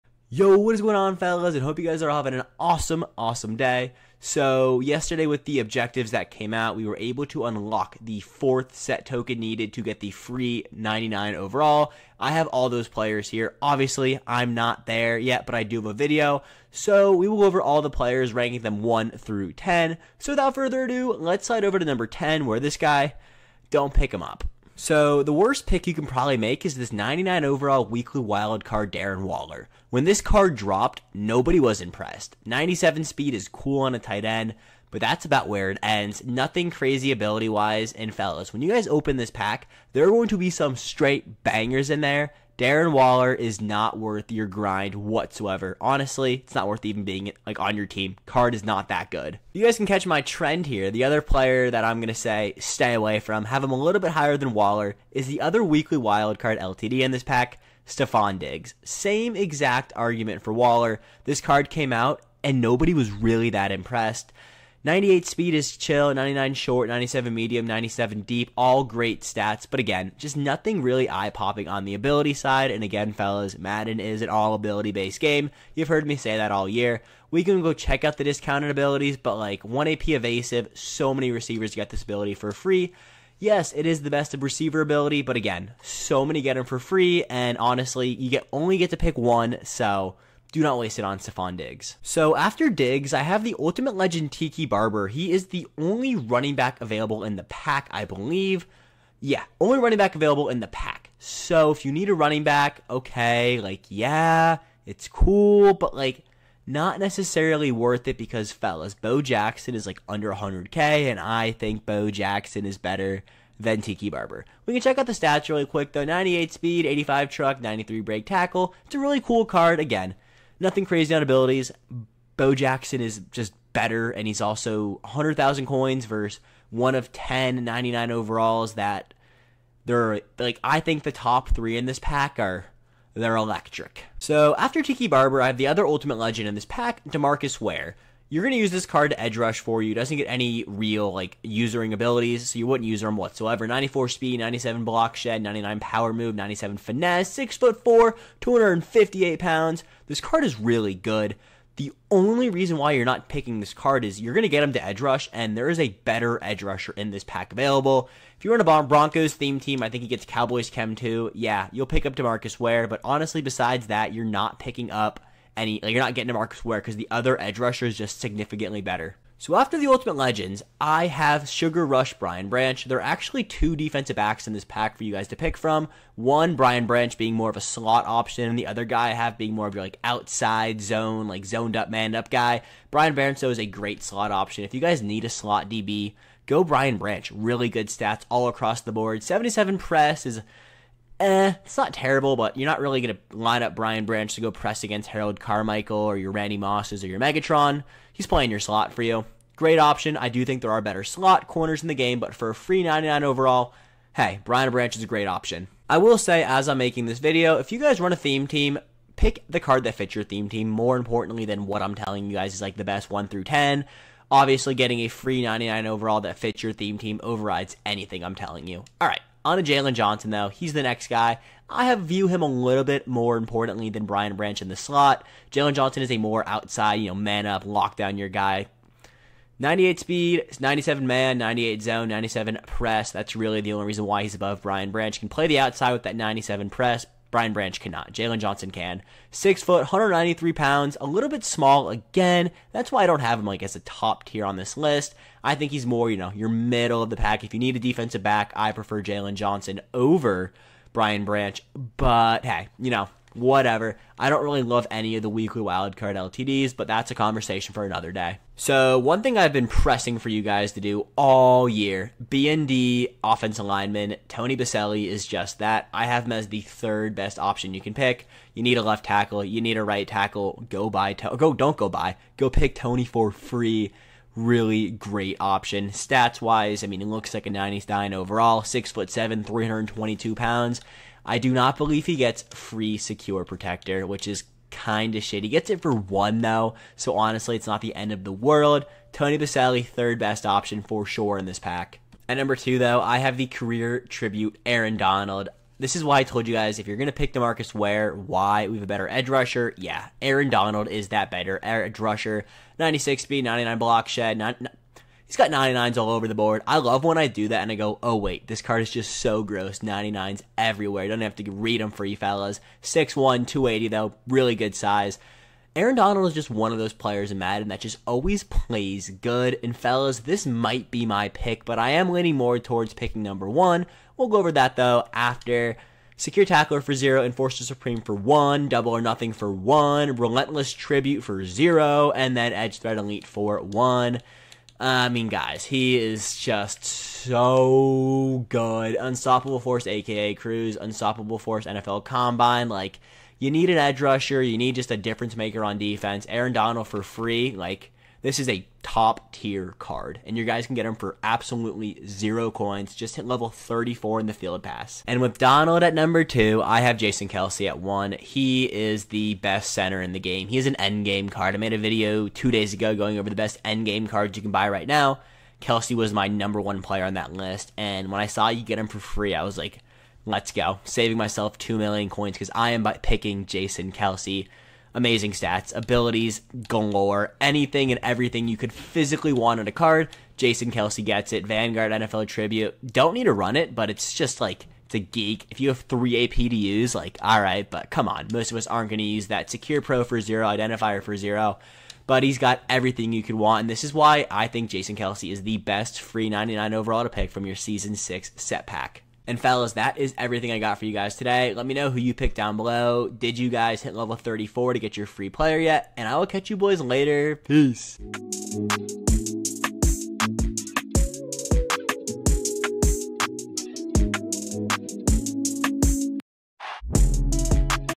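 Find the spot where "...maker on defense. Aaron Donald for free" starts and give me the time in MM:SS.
05:45.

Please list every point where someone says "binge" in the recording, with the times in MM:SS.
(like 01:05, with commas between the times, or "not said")
not said.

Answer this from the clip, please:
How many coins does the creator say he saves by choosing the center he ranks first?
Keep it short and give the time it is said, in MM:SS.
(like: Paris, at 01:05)
2 million, at 06:11.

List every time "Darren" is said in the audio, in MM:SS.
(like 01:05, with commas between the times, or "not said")
00:28, 00:42.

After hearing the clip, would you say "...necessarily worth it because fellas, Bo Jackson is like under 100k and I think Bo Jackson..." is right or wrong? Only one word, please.
right.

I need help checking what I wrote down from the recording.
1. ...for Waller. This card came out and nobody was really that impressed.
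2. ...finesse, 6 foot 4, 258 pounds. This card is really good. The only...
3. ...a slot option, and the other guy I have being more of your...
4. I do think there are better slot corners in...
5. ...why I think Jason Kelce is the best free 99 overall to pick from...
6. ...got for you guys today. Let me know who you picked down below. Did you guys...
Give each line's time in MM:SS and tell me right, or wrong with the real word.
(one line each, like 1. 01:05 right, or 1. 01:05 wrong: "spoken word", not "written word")
1. 01:00 right
2. 02:26 right
3. 02:57 right
4. 03:20 right
5. 06:33 right
6. 06:40 right.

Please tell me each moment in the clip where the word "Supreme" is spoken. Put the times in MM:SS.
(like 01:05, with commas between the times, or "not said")
05:27.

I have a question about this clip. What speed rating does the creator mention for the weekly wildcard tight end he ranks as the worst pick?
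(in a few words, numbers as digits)
97.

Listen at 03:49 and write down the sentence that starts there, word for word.
98 speed, 97 man, 98 zone, 97 press.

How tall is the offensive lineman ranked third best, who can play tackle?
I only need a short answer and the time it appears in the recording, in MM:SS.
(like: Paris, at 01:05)
6'7", at 04:38.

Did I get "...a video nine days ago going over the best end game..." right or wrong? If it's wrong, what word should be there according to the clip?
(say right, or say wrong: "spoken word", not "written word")
wrong: "two", not "nine".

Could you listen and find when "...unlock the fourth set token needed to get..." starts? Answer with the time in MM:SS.
00:07.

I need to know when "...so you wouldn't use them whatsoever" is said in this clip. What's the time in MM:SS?
02:22.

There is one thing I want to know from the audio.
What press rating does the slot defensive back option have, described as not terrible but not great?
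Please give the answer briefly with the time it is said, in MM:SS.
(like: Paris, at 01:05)
77, at 03:09.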